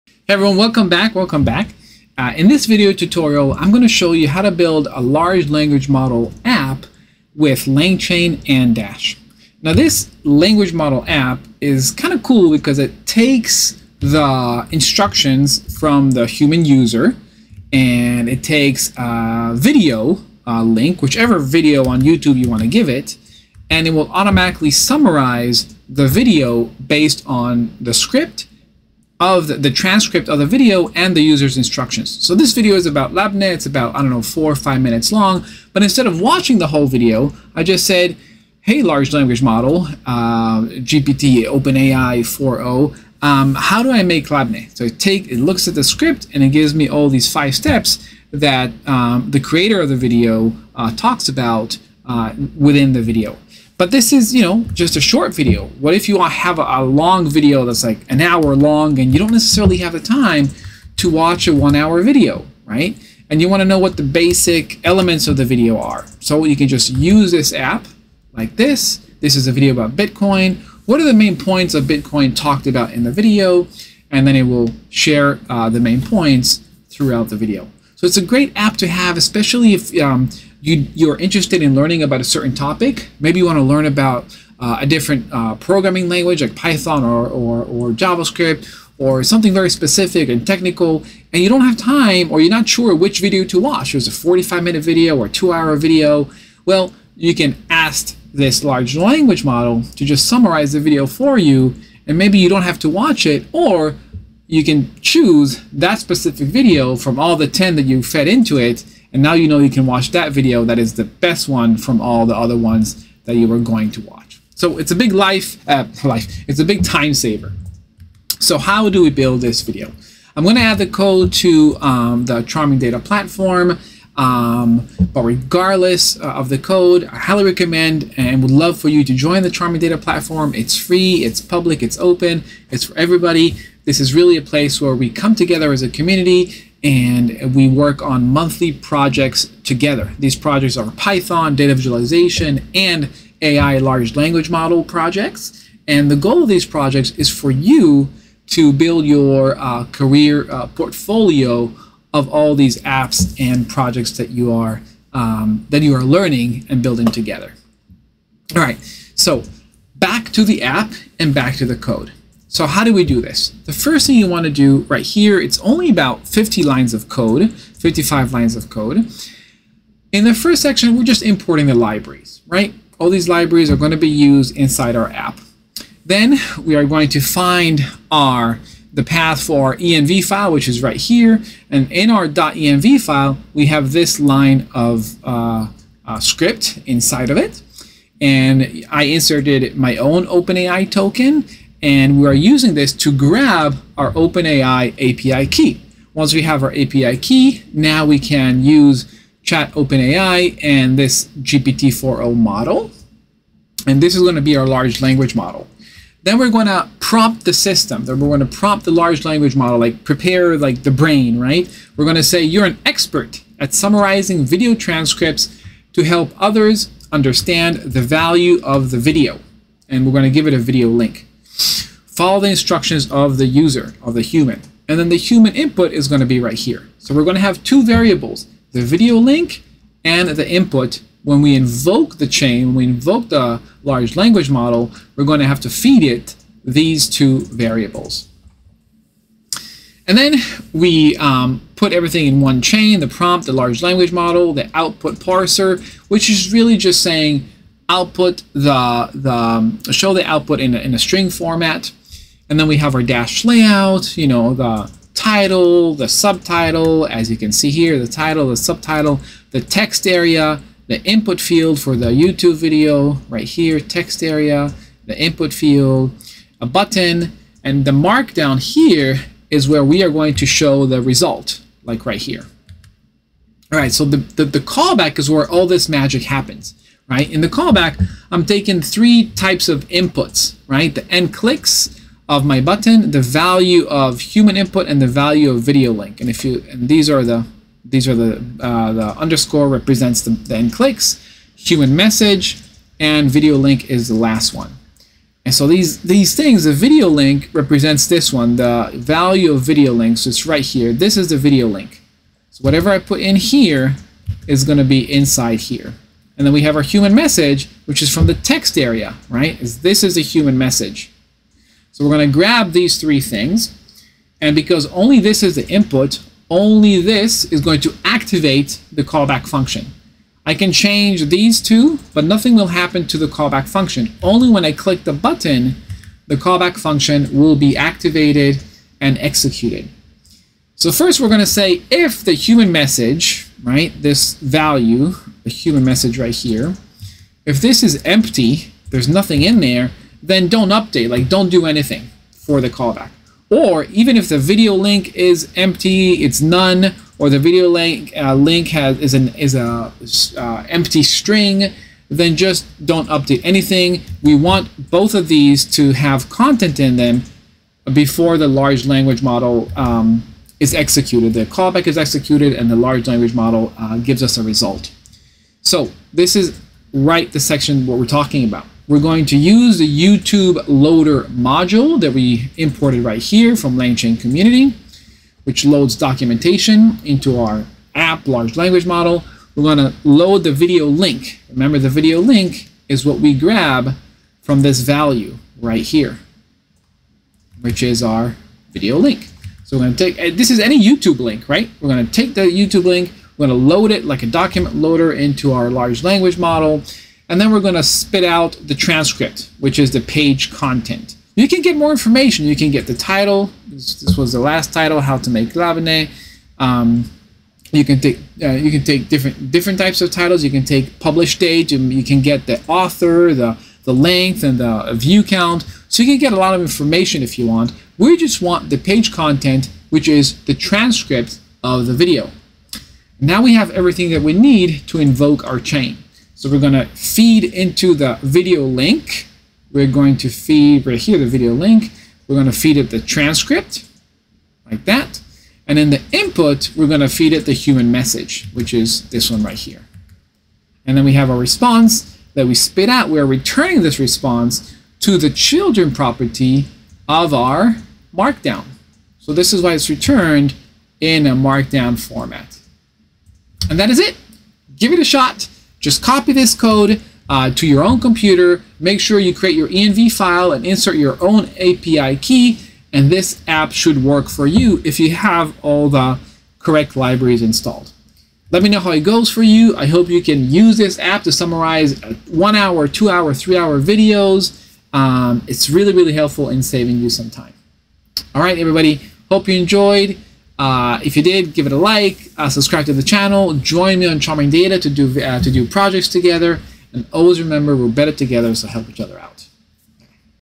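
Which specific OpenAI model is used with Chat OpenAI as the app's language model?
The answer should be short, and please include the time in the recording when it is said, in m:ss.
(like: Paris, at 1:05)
GPT-4o, at 3:21.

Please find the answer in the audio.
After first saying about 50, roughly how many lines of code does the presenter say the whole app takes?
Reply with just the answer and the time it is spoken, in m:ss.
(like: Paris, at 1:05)
55, at 2:47.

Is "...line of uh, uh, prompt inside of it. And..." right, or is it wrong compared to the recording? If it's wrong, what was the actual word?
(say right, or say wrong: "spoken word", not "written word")
wrong: "script", not "prompt".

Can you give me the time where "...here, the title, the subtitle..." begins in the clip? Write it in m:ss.
4:17.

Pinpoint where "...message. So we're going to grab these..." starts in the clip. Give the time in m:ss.
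5:10.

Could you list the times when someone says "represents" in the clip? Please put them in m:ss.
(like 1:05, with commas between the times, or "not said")
4:49, 4:57.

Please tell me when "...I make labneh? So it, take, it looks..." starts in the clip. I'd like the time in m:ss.
0:43.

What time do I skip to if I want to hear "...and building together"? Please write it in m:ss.
2:36.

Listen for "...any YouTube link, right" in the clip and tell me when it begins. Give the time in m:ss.
6:30.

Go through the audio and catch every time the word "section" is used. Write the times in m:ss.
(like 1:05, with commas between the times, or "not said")
2:50, 6:07.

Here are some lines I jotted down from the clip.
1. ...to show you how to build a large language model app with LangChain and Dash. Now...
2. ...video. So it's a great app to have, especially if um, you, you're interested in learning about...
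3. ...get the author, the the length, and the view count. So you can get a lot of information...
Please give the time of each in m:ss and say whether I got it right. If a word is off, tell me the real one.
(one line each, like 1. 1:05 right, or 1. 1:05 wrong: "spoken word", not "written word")
1. 0:03 right
2. 1:17 right
3. 6:52 right.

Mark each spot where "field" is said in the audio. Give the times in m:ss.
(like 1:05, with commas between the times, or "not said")
4:21, 4:25.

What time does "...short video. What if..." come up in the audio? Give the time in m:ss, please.
0:55.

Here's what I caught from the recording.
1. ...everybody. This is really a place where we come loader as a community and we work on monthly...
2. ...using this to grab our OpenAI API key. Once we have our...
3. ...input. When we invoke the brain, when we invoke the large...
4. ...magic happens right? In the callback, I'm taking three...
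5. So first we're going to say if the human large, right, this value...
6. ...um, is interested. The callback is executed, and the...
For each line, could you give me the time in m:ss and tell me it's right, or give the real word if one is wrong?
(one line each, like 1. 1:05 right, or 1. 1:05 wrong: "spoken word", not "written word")
1. 2:12 wrong: "together", not "loader"
2. 3:12 right
3. 3:50 wrong: "chain", not "brain"
4. 4:35 right
5. 5:30 wrong: "message", not "large"
6. 5:59 wrong: "executed", not "interested".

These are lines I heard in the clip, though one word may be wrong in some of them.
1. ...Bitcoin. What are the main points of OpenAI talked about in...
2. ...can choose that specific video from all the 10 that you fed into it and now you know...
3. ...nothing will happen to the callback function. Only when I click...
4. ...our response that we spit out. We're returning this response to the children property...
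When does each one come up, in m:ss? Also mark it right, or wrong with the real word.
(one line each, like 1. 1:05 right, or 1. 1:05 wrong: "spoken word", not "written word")
1. 1:09 wrong: "Bitcoin", not "OpenAI"
2. 1:44 right
3. 5:22 right
4. 7:21 right.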